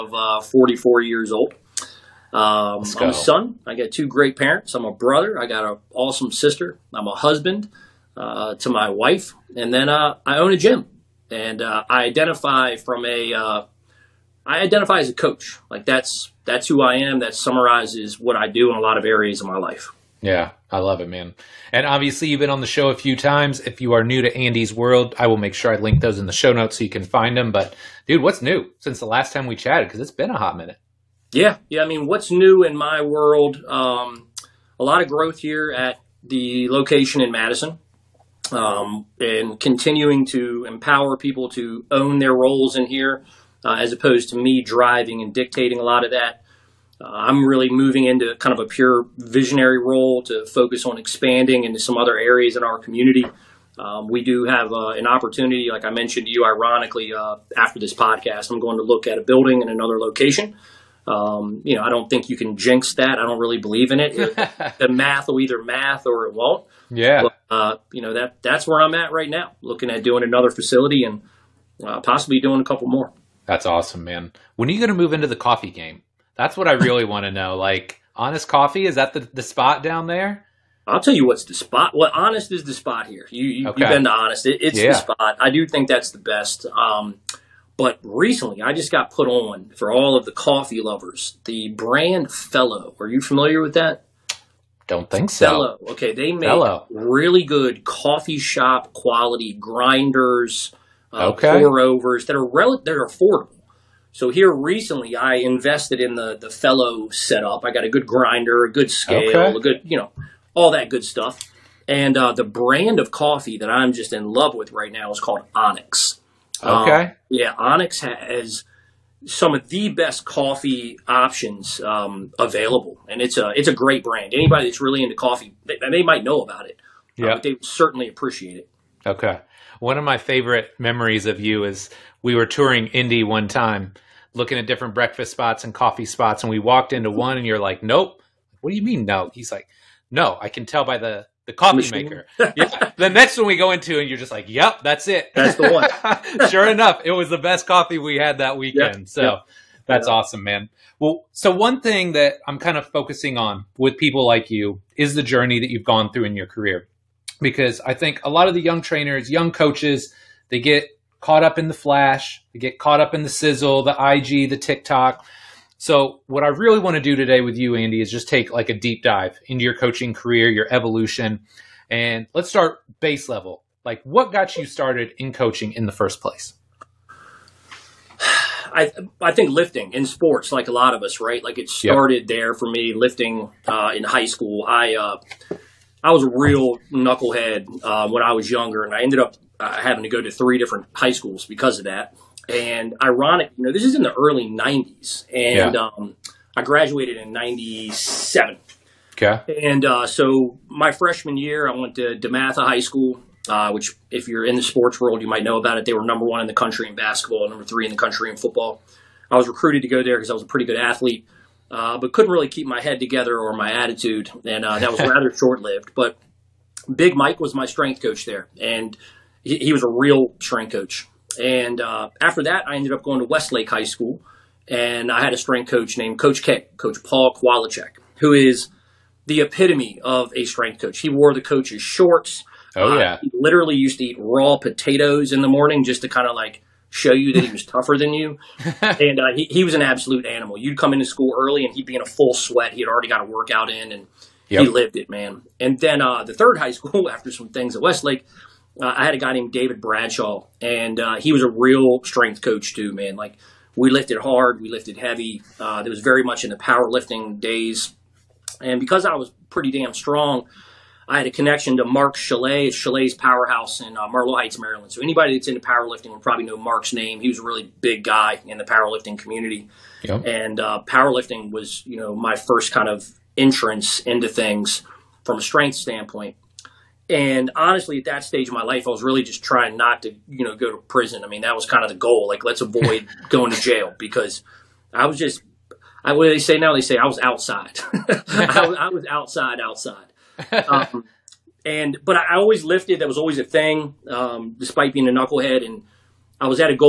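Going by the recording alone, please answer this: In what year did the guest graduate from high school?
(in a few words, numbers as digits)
1997.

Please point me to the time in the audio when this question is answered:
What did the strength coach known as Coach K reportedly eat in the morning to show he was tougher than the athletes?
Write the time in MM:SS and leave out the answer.
03:54.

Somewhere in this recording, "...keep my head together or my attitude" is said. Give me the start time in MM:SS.
03:32.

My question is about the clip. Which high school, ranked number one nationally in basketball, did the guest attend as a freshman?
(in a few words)
DeMatha High School.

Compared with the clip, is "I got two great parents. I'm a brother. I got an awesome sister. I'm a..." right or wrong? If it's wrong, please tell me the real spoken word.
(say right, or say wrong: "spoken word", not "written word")
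right.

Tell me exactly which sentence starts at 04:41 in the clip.
I mean, that was kind of the goal.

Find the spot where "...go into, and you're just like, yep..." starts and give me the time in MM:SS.
02:23.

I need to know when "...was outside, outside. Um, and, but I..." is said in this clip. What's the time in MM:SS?
04:48.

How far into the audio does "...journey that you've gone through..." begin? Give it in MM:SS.
02:35.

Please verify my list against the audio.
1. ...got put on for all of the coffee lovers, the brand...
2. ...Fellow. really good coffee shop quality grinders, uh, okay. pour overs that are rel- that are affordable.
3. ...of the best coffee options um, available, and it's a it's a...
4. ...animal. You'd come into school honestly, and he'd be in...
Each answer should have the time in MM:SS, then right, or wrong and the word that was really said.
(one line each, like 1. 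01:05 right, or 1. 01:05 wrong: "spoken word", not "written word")
1. 01:28 right
2. 01:36 right
3. 01:59 right
4. 04:00 wrong: "early", not "honestly".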